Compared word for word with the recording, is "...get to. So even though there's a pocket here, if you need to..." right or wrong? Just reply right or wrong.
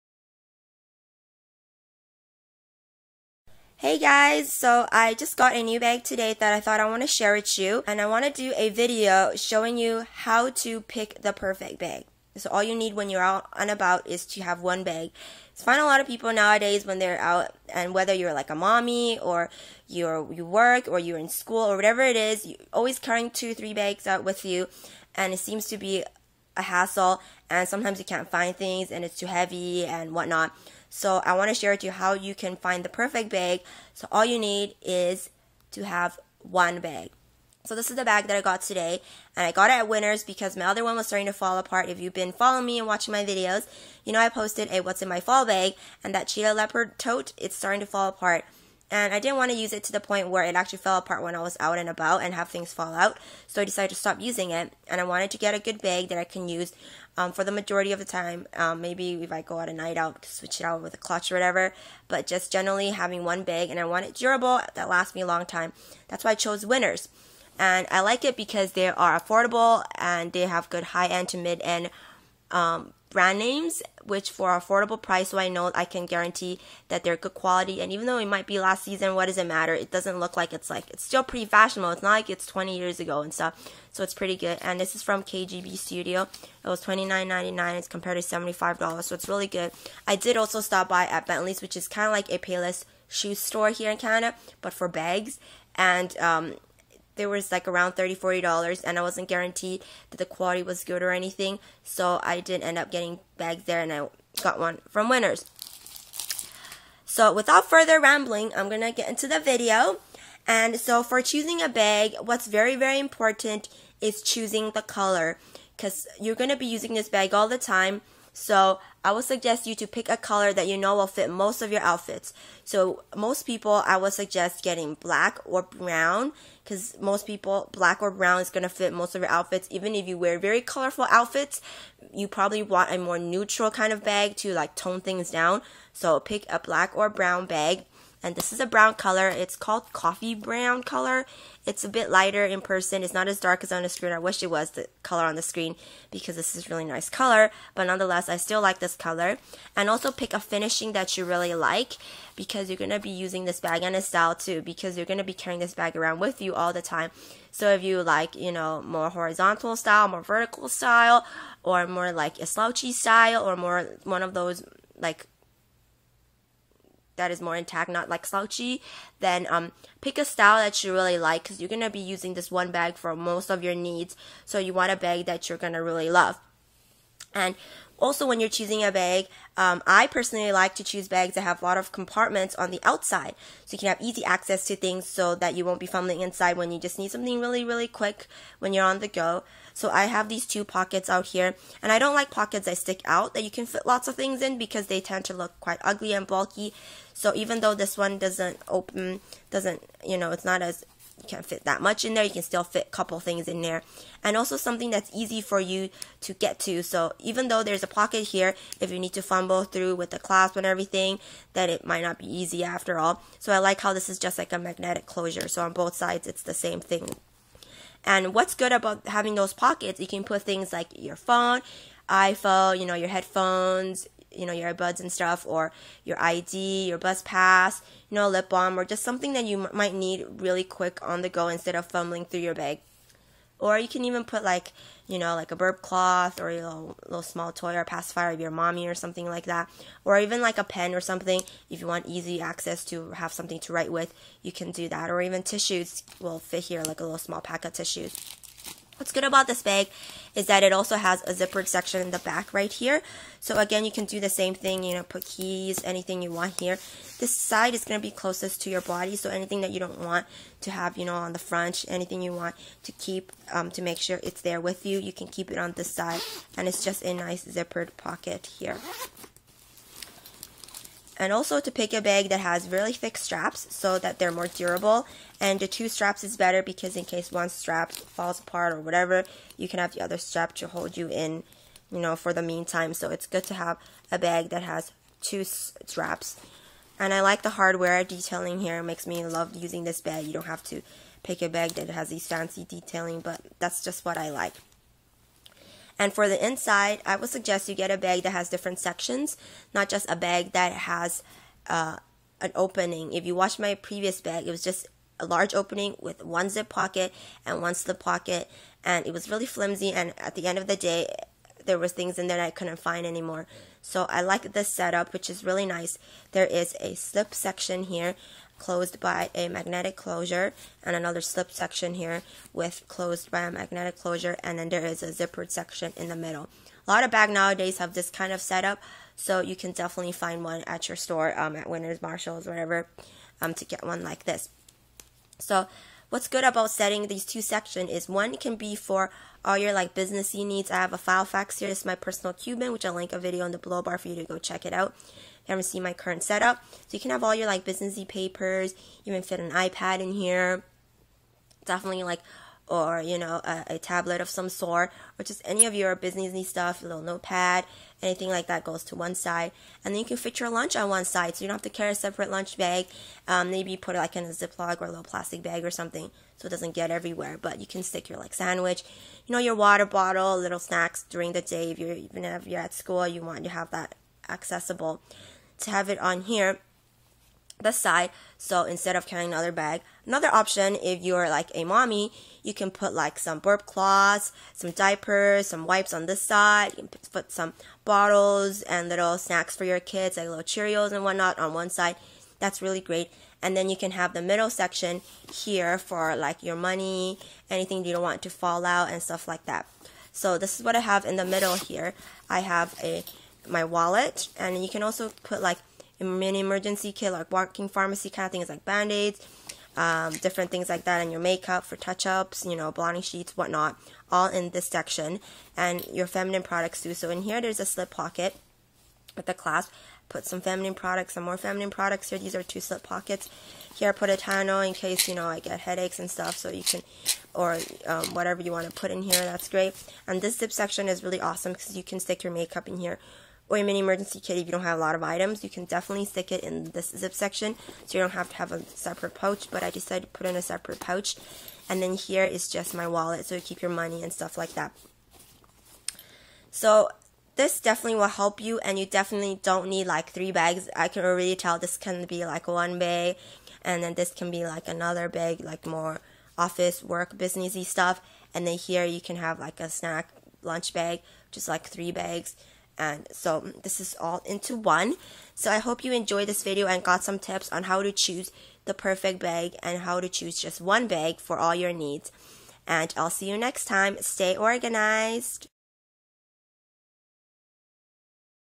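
right.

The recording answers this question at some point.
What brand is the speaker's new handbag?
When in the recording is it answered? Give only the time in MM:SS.
01:25.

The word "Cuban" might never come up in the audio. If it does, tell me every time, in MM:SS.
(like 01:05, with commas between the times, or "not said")
05:42.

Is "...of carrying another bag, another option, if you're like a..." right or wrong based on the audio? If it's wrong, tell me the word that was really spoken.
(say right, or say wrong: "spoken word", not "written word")
right.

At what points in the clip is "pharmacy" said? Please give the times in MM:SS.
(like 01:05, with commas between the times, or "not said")
06:47.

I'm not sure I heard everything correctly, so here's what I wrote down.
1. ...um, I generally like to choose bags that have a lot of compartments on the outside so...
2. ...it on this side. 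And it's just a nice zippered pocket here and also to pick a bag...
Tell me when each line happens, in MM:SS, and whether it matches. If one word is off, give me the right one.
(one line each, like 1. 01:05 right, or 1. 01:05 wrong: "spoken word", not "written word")
1. 02:59 wrong: "personally", not "generally"
2. 04:25 right.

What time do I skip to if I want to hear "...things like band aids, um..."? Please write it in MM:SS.
06:48.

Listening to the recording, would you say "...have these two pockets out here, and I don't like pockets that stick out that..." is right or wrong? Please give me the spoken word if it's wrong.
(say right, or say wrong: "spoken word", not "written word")
right.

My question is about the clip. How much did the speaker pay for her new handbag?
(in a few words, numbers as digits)
$29.99.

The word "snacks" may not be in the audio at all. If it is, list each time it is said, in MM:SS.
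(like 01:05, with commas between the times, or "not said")
06:10, 06:29, 07:39.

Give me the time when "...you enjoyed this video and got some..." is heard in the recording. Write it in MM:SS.
07:45.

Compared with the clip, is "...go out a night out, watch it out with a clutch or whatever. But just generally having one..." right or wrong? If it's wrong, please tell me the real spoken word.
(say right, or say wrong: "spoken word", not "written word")
wrong: "switch", not "watch".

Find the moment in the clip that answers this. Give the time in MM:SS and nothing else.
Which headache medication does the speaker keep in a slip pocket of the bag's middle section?
07:04.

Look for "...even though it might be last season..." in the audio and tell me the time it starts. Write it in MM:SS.
01:17.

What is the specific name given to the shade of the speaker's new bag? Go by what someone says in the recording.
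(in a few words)
coffee brown.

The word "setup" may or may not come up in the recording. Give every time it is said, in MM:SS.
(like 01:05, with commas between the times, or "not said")
05:14, 05:28, 05:46.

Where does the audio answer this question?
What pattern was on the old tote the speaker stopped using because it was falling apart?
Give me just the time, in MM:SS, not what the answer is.
00:46.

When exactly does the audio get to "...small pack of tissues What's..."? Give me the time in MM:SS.
04:07.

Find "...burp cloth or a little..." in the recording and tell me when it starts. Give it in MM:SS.
03:55.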